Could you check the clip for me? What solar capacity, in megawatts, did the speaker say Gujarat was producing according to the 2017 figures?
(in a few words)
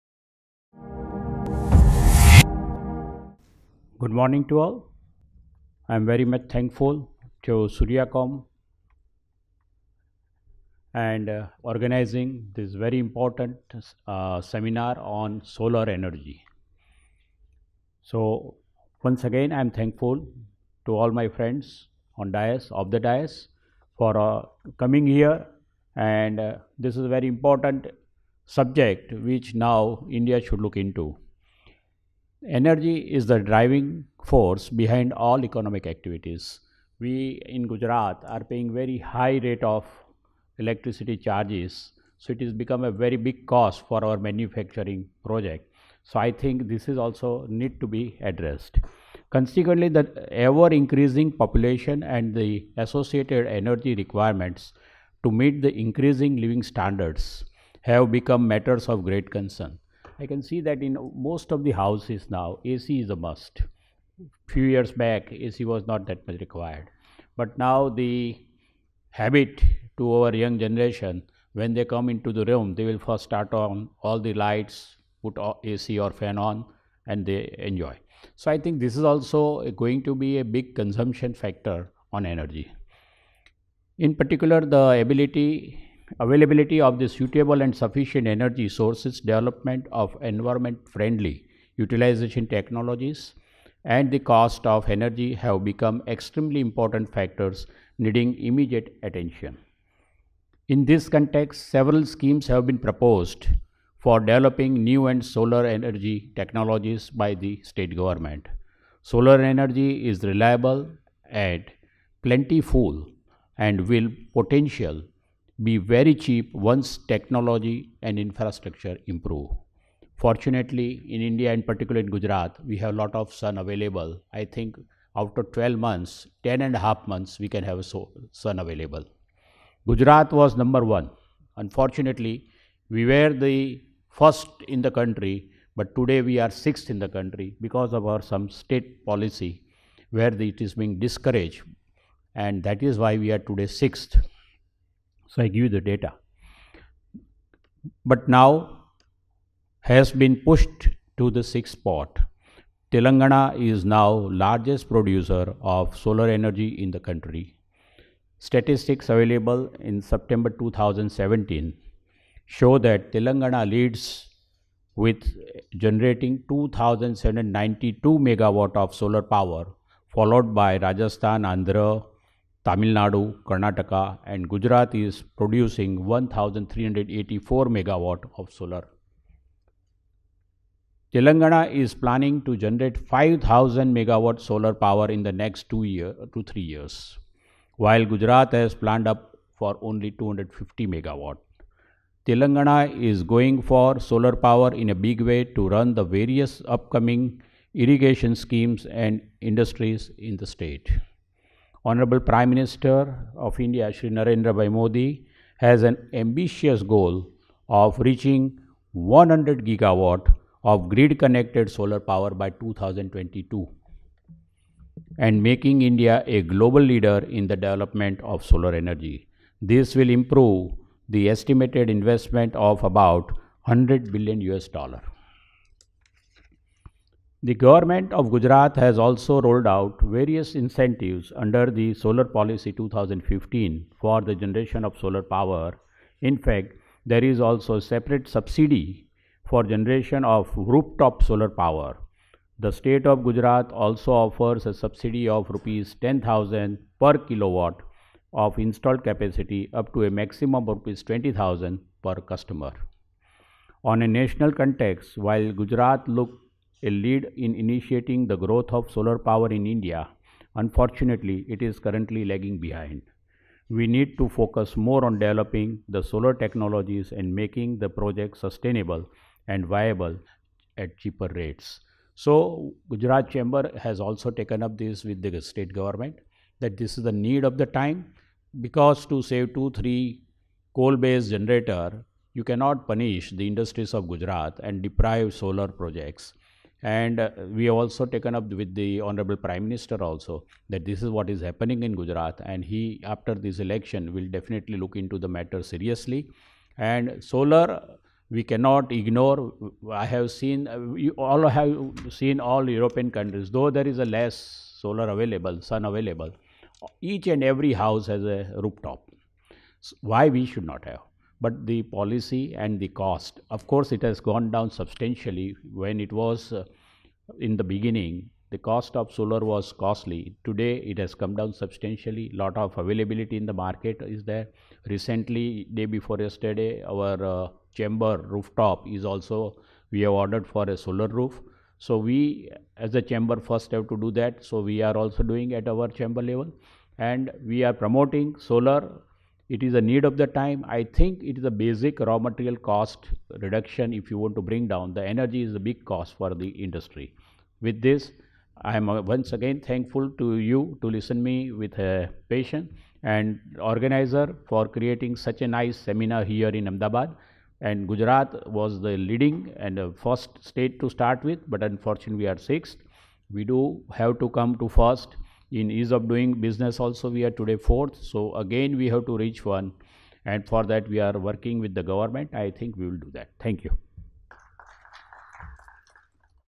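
1,384 megawatts.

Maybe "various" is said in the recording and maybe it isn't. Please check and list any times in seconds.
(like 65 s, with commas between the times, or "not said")
196 s, 229 s.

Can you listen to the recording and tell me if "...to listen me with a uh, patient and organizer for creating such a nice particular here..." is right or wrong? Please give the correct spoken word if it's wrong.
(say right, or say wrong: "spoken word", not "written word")
wrong: "seminar", not "particular".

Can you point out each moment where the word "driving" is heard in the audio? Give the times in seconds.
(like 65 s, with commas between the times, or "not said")
33 s.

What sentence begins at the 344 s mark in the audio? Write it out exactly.
The energy is a big cost for the industry.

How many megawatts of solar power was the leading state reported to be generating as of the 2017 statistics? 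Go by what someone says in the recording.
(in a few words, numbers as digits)
2792 megawatts.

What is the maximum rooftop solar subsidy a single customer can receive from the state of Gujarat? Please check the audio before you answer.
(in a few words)
Rs 20,000.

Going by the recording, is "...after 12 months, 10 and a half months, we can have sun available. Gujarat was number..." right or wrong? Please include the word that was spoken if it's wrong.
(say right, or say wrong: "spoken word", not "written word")
right.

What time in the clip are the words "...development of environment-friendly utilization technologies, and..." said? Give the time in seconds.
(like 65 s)
89 s.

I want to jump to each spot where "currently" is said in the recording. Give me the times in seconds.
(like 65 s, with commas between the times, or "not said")
261 s.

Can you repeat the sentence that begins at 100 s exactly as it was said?
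In this context, several schemes have been proposed for developing new and solar energy technologies by the state government.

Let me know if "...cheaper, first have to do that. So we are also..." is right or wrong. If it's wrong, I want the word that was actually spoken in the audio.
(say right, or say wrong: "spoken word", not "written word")
wrong: "chamber", not "cheaper".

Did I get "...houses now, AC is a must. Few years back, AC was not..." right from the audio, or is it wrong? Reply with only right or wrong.
right.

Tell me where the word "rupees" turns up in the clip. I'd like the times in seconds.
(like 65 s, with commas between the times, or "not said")
245 s, 250 s.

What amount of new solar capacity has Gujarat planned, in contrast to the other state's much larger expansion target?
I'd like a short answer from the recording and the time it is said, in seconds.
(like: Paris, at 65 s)
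250 megawatts, at 190 s.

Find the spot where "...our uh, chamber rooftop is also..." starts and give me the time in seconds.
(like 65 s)
326 s.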